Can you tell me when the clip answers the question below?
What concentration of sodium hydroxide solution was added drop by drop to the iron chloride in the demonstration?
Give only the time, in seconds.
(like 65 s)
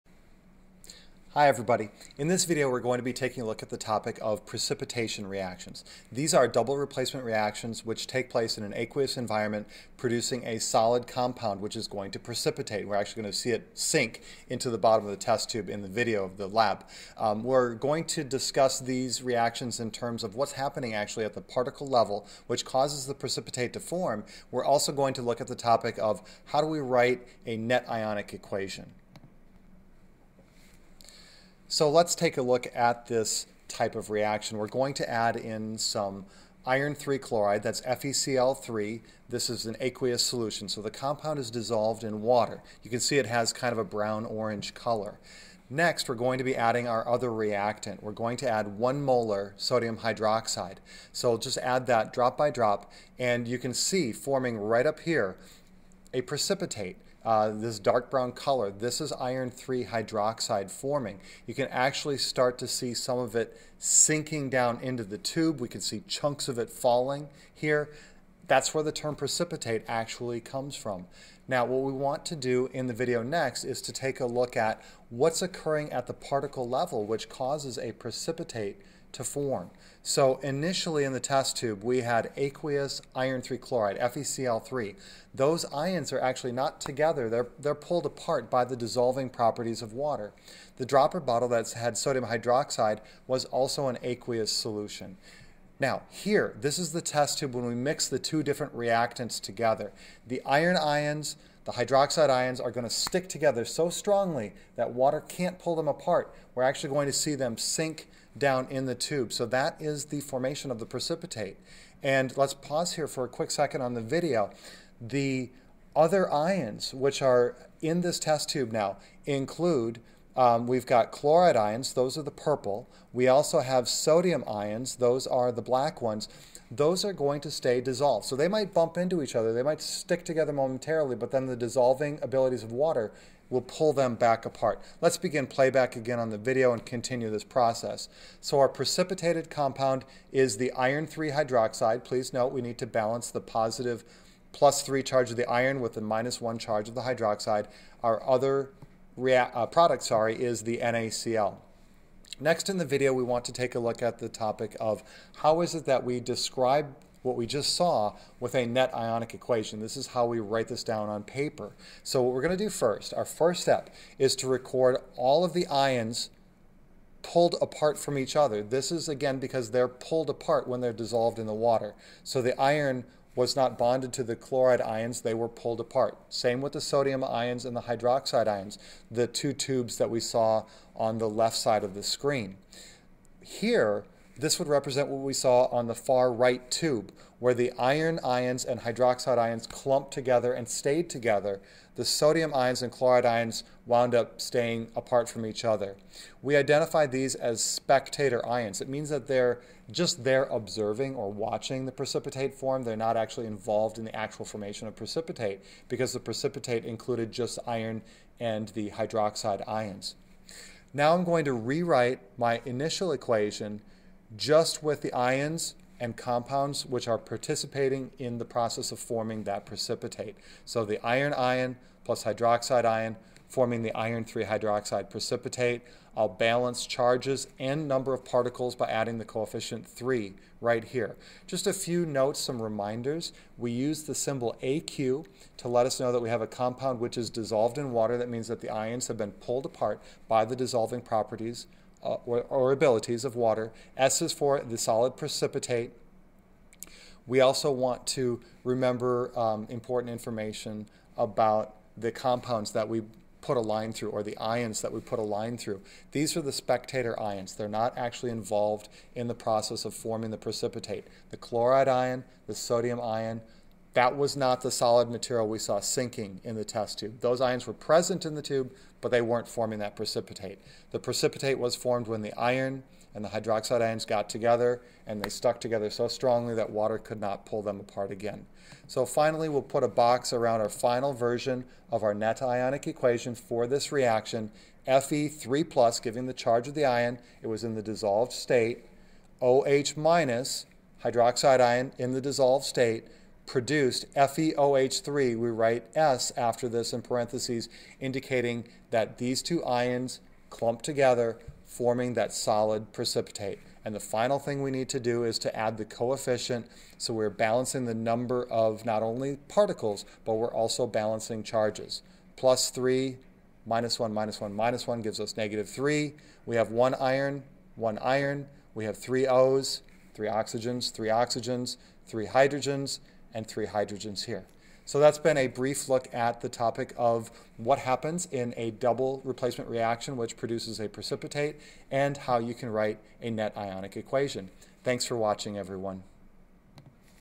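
48 s.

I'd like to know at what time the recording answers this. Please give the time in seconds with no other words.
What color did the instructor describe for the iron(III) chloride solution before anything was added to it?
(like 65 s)
43 s.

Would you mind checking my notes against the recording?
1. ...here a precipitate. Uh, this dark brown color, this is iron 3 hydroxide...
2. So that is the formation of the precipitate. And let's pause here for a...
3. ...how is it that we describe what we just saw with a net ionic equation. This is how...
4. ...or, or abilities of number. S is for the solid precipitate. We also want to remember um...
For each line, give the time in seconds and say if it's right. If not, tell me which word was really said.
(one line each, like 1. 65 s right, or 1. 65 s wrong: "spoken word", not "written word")
1. 54 s right
2. 109 s right
3. 155 s right
4. 242 s wrong: "water", not "number".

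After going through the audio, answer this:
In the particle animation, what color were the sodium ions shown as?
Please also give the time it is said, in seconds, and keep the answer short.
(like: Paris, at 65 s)
black, at 125 s.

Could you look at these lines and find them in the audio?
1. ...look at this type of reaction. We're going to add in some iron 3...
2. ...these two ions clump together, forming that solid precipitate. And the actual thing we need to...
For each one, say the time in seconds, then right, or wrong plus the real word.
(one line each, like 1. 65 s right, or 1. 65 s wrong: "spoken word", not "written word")
1. 32 s right
2. 299 s wrong: "final", not "actual".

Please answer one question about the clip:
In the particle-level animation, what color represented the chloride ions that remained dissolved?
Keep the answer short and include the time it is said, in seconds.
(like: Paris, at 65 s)
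purple, at 122 s.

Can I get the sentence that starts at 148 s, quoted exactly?
Our other uh, product sorry, is the NaCl.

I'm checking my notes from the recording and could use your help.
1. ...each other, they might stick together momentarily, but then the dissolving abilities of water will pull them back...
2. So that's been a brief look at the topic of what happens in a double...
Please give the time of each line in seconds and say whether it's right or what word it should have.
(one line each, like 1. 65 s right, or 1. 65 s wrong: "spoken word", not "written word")
1. 129 s right
2. 324 s right.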